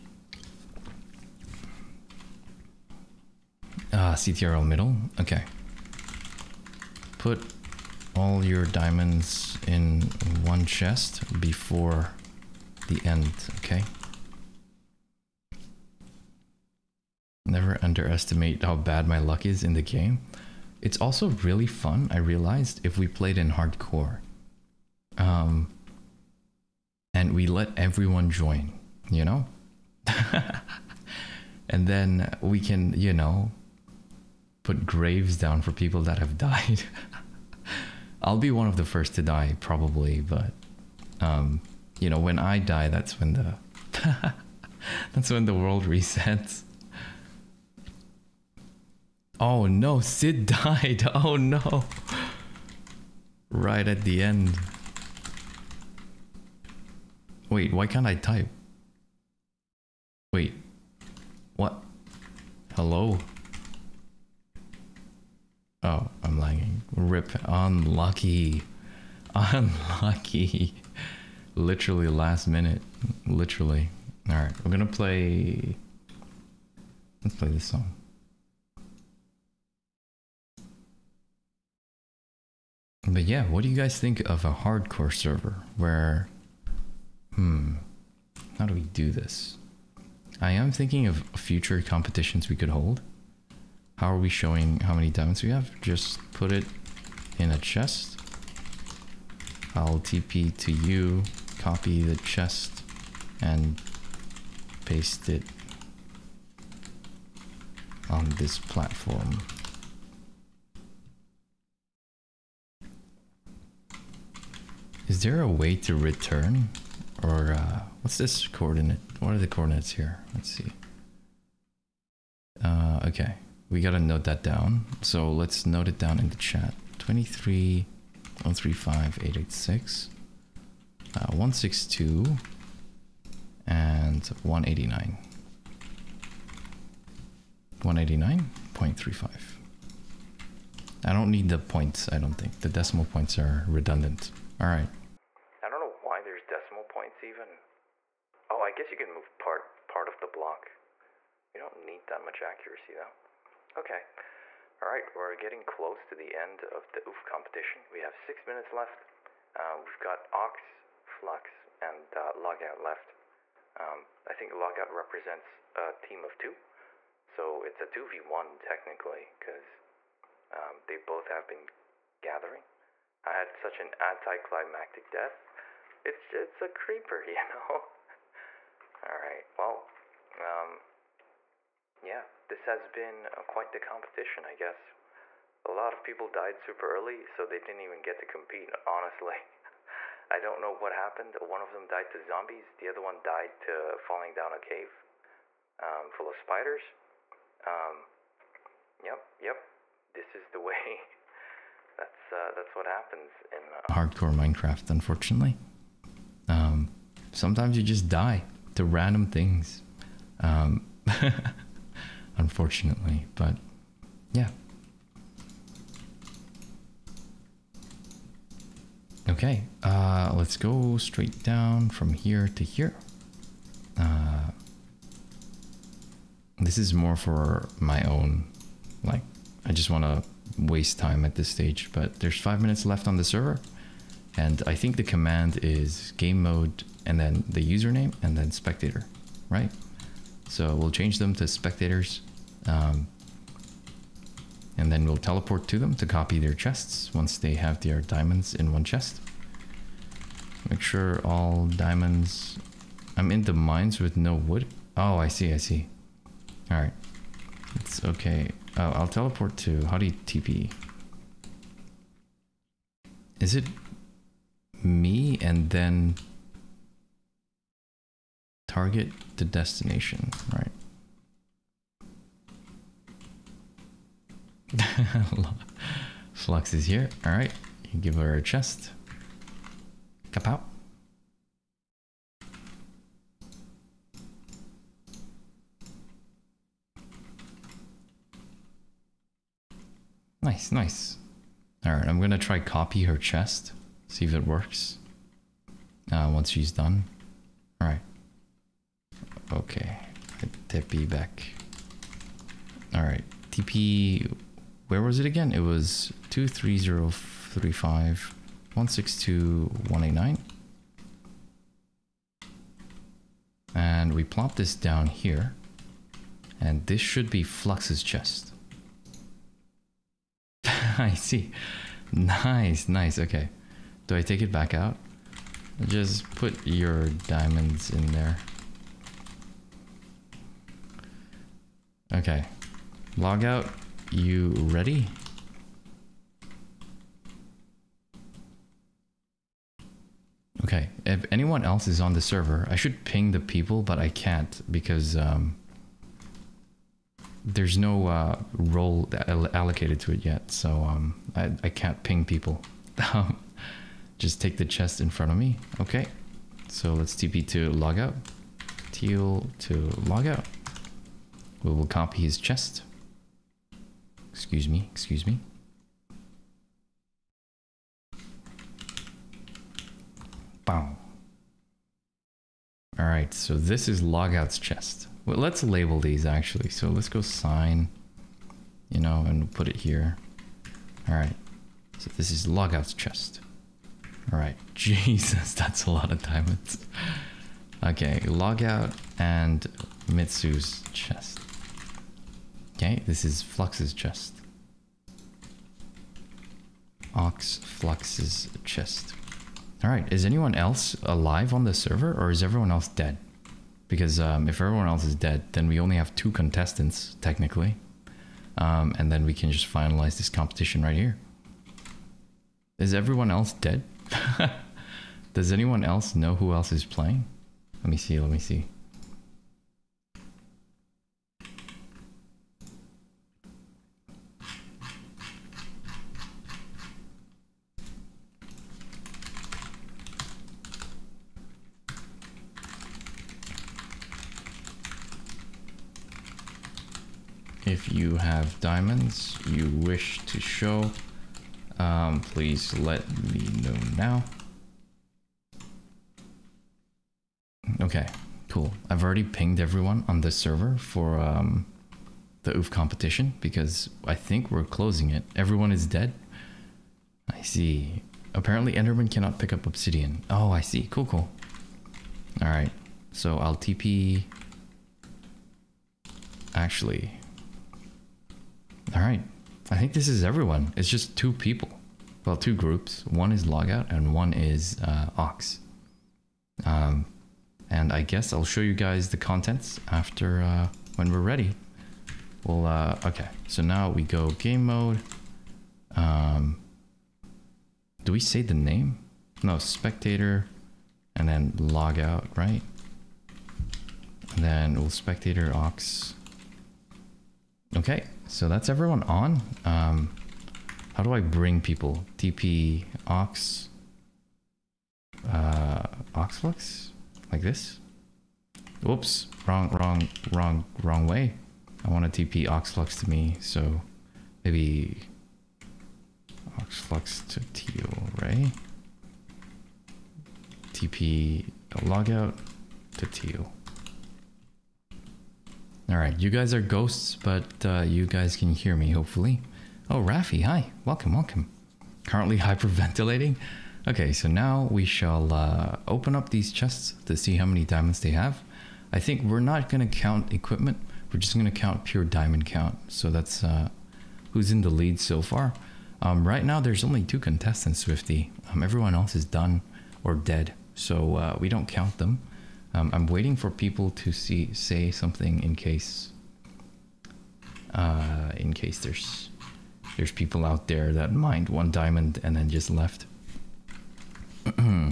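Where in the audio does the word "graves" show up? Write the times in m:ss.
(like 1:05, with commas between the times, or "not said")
0:34.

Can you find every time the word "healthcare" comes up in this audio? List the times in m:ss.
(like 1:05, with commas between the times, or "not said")
not said.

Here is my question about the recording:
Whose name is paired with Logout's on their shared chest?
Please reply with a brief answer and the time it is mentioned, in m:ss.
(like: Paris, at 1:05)
Mitsu, at 6:30.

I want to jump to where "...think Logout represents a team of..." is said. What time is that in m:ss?
2:44.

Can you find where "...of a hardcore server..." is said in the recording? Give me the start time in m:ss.
1:24.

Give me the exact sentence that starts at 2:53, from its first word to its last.
I had such an anticlimactic death.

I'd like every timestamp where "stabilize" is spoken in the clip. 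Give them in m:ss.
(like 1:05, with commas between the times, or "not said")
not said.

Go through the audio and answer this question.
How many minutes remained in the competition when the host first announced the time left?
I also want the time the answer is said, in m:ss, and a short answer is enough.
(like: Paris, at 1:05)
6, at 2:38.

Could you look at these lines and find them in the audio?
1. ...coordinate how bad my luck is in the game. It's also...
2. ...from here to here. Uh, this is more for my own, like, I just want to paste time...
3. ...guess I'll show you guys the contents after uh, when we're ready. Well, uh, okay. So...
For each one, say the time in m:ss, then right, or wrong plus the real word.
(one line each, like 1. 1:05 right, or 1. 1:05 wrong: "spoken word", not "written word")
1. 0:17 wrong: "underestimate", not "coordinate"
2. 3:41 wrong: "waste", not "paste"
3. 7:58 right.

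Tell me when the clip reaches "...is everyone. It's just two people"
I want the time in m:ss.
7:50.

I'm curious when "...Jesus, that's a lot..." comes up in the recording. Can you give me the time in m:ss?
6:24.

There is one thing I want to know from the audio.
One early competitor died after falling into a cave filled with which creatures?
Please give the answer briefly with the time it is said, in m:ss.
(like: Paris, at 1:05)
spiders, at 3:16.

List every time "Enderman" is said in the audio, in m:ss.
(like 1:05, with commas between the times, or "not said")
7:38.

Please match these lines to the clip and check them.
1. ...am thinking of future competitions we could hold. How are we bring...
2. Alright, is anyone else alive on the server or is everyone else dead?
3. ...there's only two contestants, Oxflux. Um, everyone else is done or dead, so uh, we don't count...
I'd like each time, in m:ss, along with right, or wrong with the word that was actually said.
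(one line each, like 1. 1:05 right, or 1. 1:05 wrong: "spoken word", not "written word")
1. 1:30 wrong: "showing", not "bring"
2. 6:39 right
3. 9:06 wrong: "Swifty", not "Oxflux".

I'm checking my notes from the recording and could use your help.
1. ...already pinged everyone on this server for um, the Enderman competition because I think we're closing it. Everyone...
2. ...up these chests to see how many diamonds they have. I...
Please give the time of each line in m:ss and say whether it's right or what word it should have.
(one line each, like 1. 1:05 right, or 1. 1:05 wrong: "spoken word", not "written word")
1. 7:29 wrong: "OOF", not "Enderman"
2. 8:56 right.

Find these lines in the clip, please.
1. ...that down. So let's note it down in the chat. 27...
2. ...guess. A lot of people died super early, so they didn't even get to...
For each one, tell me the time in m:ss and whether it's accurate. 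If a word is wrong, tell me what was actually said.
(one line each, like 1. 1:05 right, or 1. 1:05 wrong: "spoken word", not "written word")
1. 2:04 wrong: "23", not "27"
2. 3:04 right.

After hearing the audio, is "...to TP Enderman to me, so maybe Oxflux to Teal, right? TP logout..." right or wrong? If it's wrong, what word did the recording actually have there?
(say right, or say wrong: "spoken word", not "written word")
wrong: "Oxflux", not "Enderman".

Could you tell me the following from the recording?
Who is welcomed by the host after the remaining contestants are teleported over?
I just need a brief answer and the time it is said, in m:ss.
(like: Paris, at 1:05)
Rafi, at 8:50.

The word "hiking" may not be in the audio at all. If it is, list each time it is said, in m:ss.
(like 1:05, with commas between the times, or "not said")
not said.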